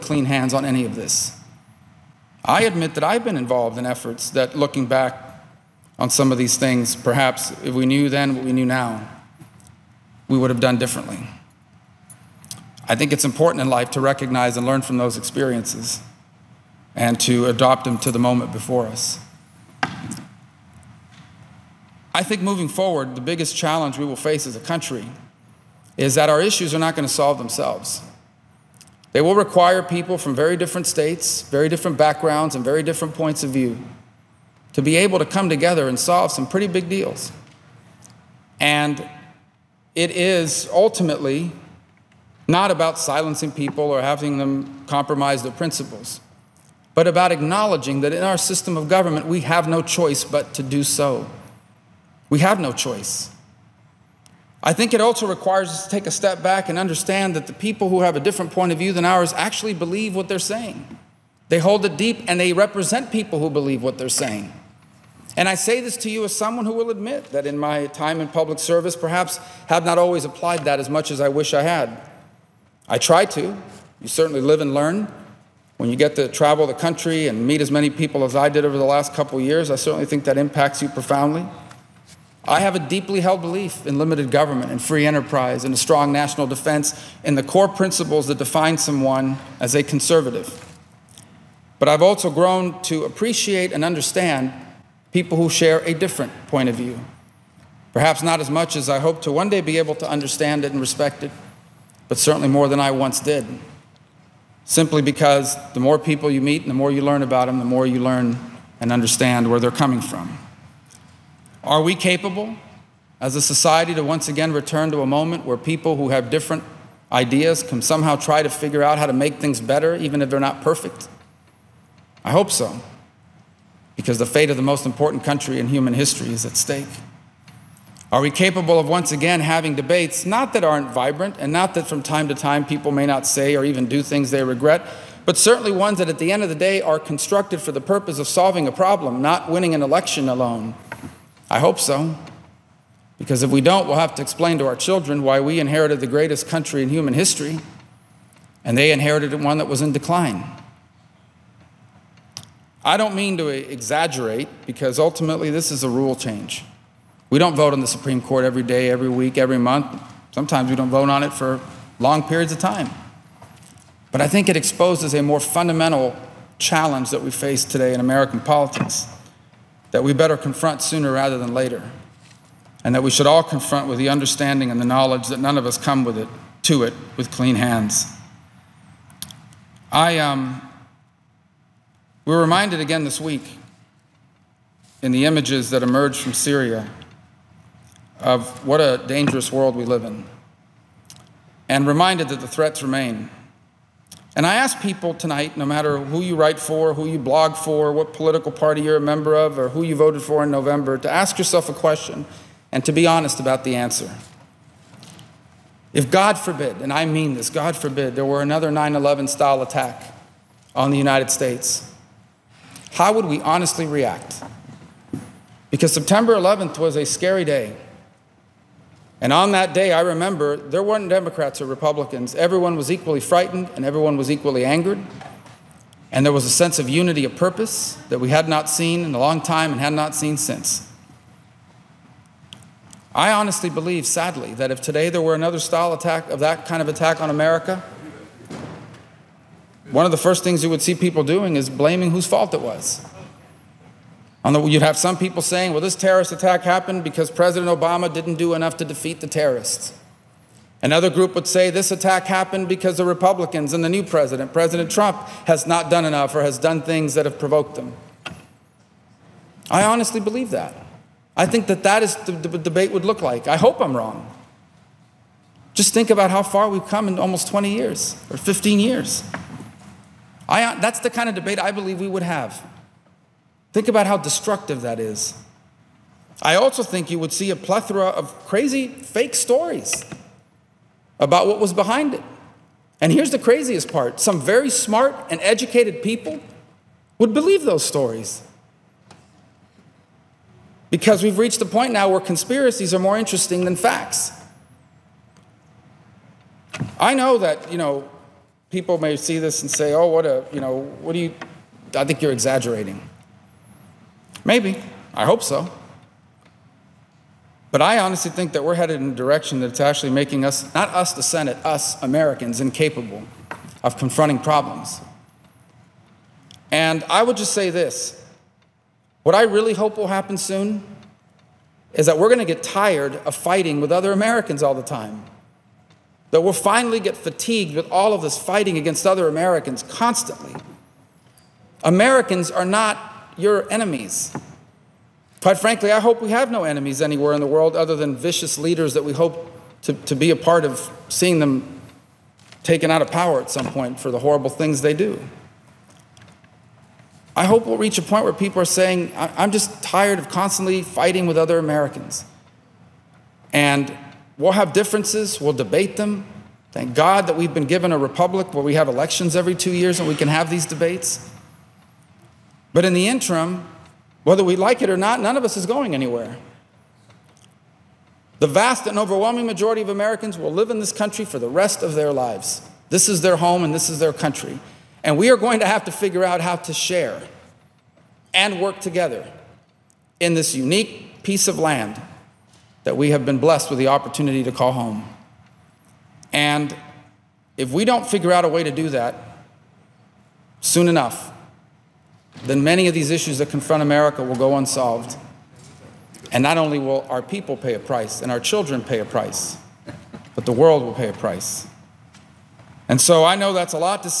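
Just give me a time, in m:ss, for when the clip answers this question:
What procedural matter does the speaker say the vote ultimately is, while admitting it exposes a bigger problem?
2:35.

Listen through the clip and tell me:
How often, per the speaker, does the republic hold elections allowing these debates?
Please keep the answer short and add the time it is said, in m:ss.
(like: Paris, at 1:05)
every 2 years, at 5:59.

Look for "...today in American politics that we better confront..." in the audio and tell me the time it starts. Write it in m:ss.
2:47.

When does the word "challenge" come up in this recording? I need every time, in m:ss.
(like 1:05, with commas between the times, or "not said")
0:23, 2:46.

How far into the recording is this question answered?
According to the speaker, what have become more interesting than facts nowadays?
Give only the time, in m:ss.
4:52.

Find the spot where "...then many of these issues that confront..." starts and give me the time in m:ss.
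6:32.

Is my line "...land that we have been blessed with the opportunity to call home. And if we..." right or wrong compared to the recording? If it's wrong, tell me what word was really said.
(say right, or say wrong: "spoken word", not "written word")
right.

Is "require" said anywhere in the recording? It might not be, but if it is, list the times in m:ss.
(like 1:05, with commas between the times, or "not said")
0:29, 0:55.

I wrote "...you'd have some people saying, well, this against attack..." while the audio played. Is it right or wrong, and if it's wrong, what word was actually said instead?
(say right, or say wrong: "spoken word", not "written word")
wrong: "terrorist", not "against".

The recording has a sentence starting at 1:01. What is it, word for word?
They hold it deep and they represent people who believe what they're saying.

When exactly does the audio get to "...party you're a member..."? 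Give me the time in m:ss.
3:18.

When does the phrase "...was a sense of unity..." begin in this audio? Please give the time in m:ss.
3:46.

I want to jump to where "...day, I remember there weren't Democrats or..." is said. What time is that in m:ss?
3:39.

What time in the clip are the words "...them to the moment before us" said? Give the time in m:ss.
0:17.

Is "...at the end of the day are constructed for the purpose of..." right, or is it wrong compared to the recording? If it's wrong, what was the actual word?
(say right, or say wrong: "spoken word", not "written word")
right.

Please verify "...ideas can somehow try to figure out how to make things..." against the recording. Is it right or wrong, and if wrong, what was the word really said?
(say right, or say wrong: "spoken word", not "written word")
right.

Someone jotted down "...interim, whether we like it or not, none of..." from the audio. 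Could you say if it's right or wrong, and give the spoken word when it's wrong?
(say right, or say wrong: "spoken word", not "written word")
right.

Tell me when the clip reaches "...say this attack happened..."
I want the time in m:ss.
4:11.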